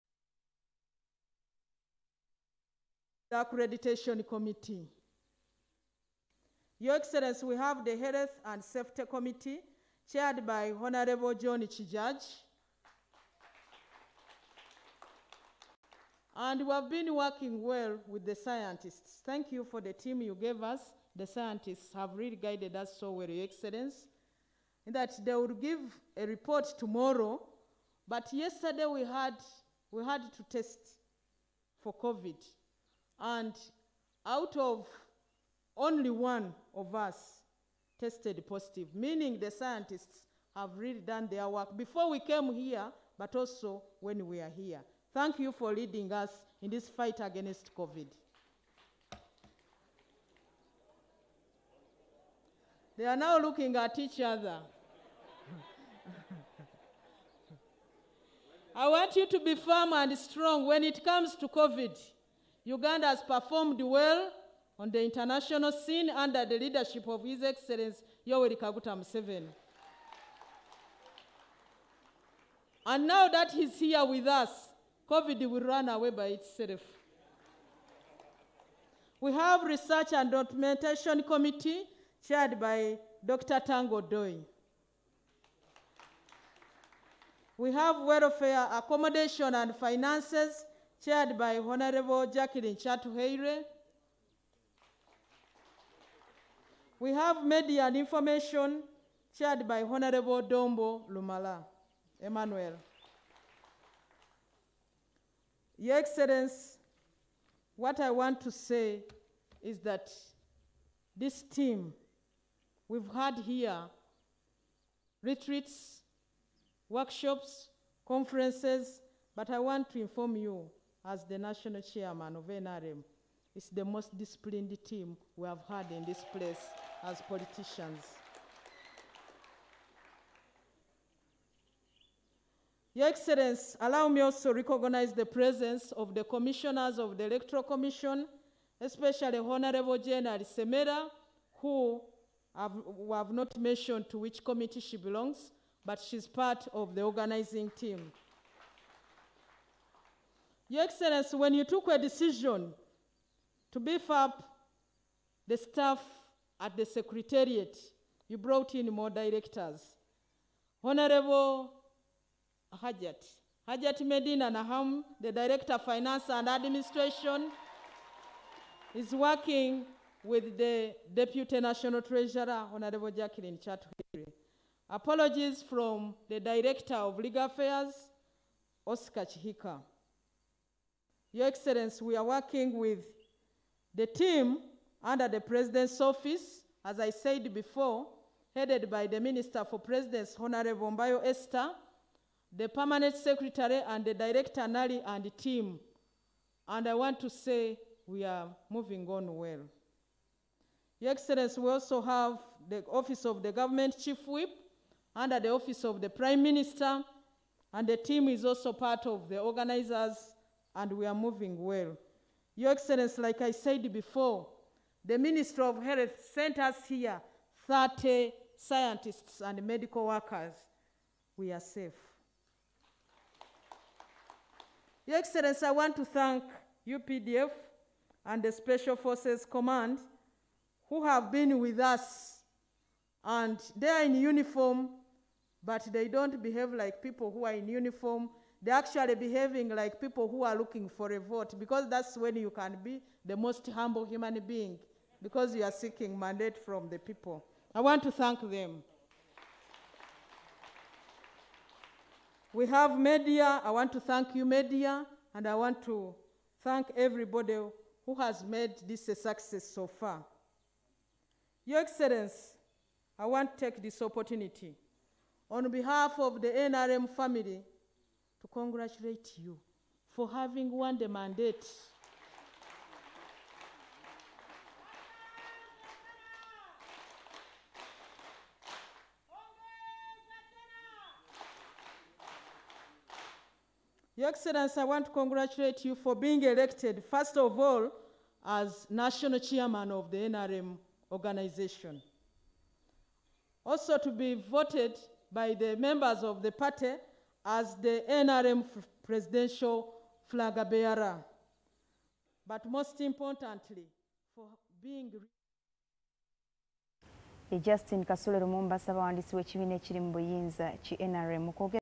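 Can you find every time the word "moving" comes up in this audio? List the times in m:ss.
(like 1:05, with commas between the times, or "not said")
3:18, 3:31.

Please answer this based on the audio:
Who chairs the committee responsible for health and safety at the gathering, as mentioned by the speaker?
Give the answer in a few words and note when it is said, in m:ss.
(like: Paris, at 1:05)
John Chijaj, at 0:10.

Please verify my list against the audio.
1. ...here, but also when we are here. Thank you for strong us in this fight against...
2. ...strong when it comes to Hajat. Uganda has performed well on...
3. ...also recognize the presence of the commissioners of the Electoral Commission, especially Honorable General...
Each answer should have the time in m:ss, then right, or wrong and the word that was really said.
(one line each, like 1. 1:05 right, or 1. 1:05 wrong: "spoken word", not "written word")
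1. 0:42 wrong: "leading", not "strong"
2. 1:00 wrong: "COVID", not "Hajat"
3. 2:14 right.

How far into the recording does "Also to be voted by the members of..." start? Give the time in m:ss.
4:53.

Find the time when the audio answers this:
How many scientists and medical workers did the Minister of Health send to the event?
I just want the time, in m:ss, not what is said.
3:37.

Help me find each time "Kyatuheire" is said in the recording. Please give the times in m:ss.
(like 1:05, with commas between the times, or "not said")
1:32, 2:53.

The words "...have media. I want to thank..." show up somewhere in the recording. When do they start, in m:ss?
4:12.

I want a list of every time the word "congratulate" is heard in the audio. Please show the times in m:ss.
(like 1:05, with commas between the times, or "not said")
4:28, 4:45.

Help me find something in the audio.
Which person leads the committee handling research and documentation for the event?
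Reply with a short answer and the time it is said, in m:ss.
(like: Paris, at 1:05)
Dr. Tanga Odoi, at 1:23.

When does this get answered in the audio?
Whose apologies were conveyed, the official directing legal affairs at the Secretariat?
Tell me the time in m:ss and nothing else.
2:58.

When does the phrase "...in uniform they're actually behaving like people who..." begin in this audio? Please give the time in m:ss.
3:57.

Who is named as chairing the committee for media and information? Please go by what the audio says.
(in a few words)
Dombo Lumala.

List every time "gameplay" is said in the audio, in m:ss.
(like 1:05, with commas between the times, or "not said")
not said.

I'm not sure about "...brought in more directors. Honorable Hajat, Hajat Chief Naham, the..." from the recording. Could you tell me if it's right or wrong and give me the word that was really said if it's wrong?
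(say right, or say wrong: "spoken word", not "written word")
wrong: "Medina", not "Chief".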